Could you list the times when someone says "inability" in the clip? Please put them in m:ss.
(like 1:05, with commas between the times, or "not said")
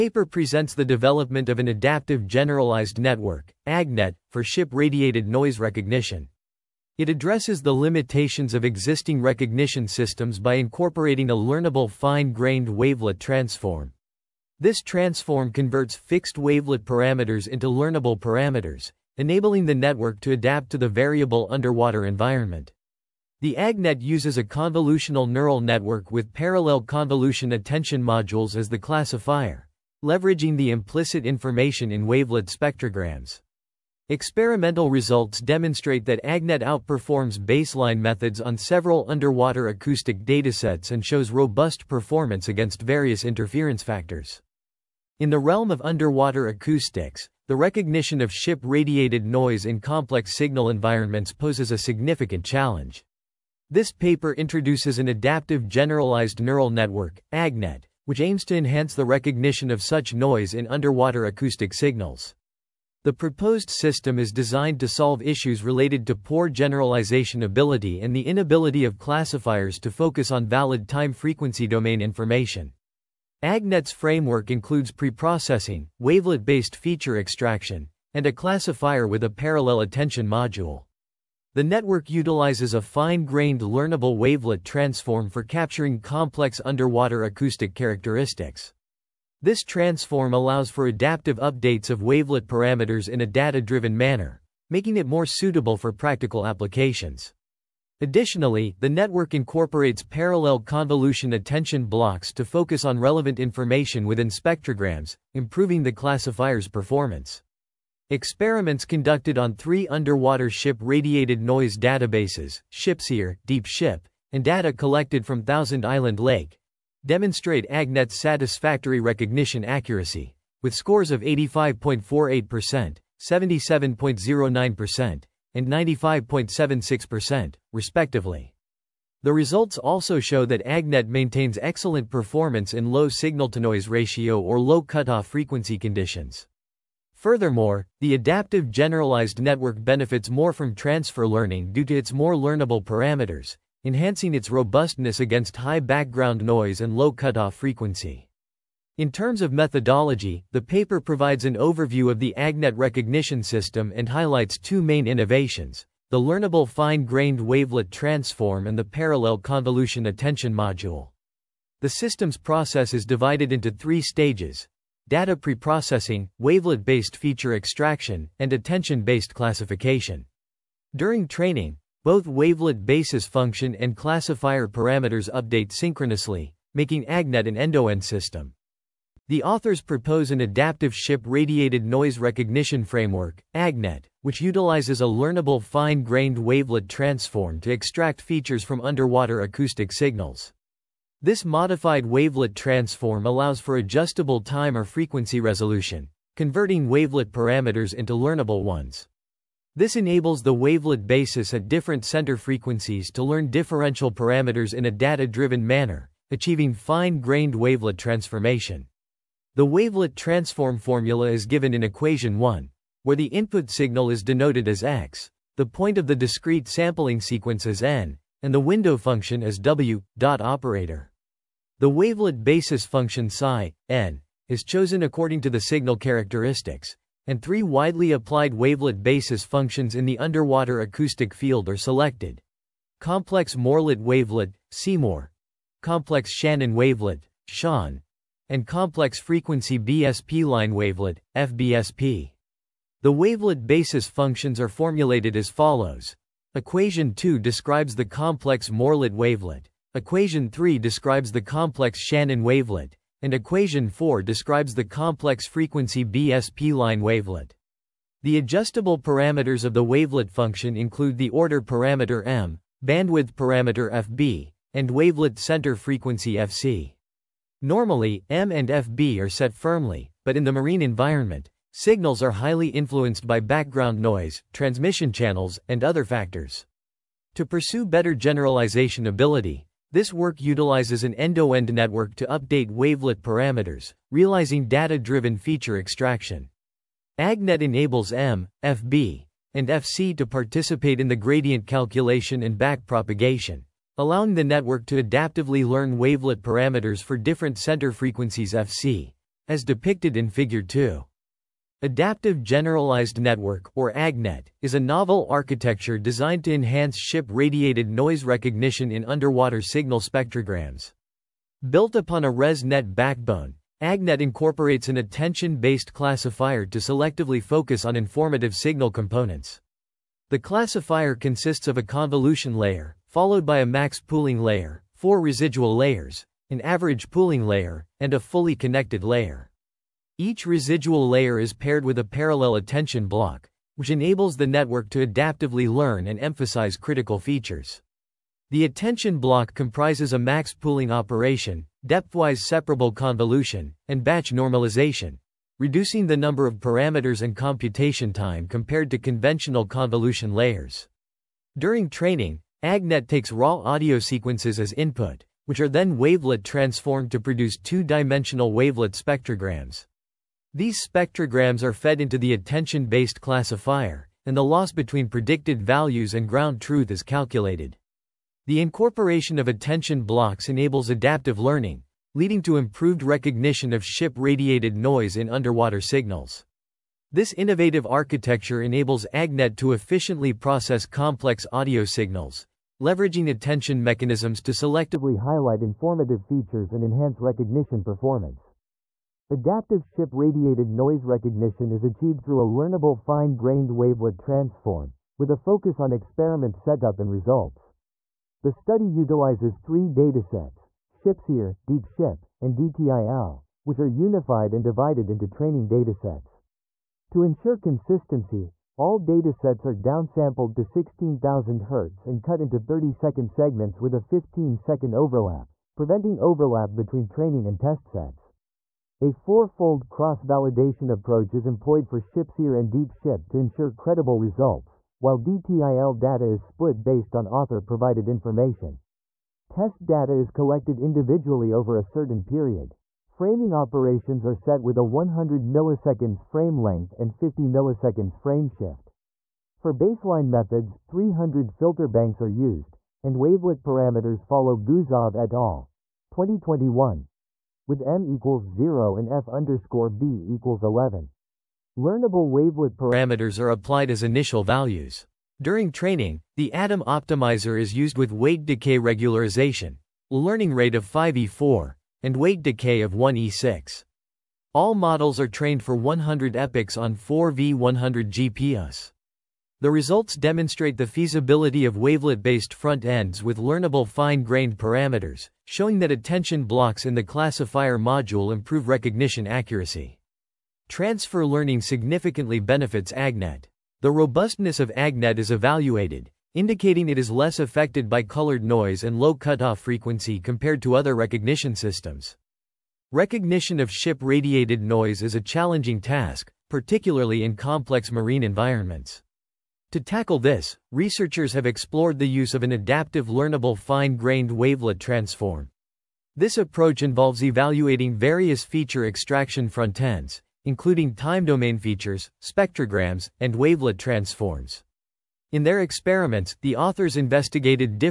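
1:08.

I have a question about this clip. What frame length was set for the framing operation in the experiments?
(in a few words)
100 milliseconds.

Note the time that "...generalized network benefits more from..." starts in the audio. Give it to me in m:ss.
2:18.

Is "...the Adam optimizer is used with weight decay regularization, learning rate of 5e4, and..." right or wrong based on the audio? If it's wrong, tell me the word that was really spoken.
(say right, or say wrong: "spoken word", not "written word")
right.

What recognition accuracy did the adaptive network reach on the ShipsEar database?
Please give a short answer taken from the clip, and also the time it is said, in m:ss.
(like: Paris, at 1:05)
85.48%, at 2:01.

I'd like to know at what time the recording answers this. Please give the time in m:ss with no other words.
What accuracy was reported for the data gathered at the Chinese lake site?
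2:05.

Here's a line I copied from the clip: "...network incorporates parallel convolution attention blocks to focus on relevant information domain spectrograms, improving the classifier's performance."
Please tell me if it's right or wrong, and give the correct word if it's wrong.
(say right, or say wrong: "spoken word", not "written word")
wrong: "within", not "domain".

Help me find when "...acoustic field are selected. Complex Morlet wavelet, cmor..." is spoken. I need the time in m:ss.
3:50.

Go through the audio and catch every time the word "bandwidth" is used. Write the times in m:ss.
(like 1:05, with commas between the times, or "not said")
4:22.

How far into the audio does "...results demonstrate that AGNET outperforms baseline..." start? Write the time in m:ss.
0:34.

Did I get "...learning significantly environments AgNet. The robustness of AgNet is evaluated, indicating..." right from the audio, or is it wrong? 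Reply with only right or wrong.
wrong.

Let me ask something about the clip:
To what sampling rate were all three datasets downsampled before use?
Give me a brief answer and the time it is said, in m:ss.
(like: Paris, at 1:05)
16,000 Hz, at 6:50.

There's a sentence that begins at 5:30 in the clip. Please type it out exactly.
Each residual layer is paired with a parallel attention block, which enables the network to adaptively learn and emphasize critical features.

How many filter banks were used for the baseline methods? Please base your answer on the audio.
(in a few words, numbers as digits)
300.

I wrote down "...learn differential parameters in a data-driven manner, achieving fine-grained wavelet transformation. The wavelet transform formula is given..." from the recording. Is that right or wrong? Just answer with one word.
right.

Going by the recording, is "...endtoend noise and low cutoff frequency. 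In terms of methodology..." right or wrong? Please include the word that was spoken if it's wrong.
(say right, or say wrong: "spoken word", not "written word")
wrong: "background", not "endtoend".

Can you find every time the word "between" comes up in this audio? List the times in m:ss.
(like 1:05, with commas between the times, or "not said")
6:04, 6:56.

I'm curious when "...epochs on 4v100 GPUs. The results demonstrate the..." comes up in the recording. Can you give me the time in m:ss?
7:46.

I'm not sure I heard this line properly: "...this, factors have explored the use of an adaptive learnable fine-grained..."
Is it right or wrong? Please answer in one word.
wrong.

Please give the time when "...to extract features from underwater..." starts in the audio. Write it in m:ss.
3:07.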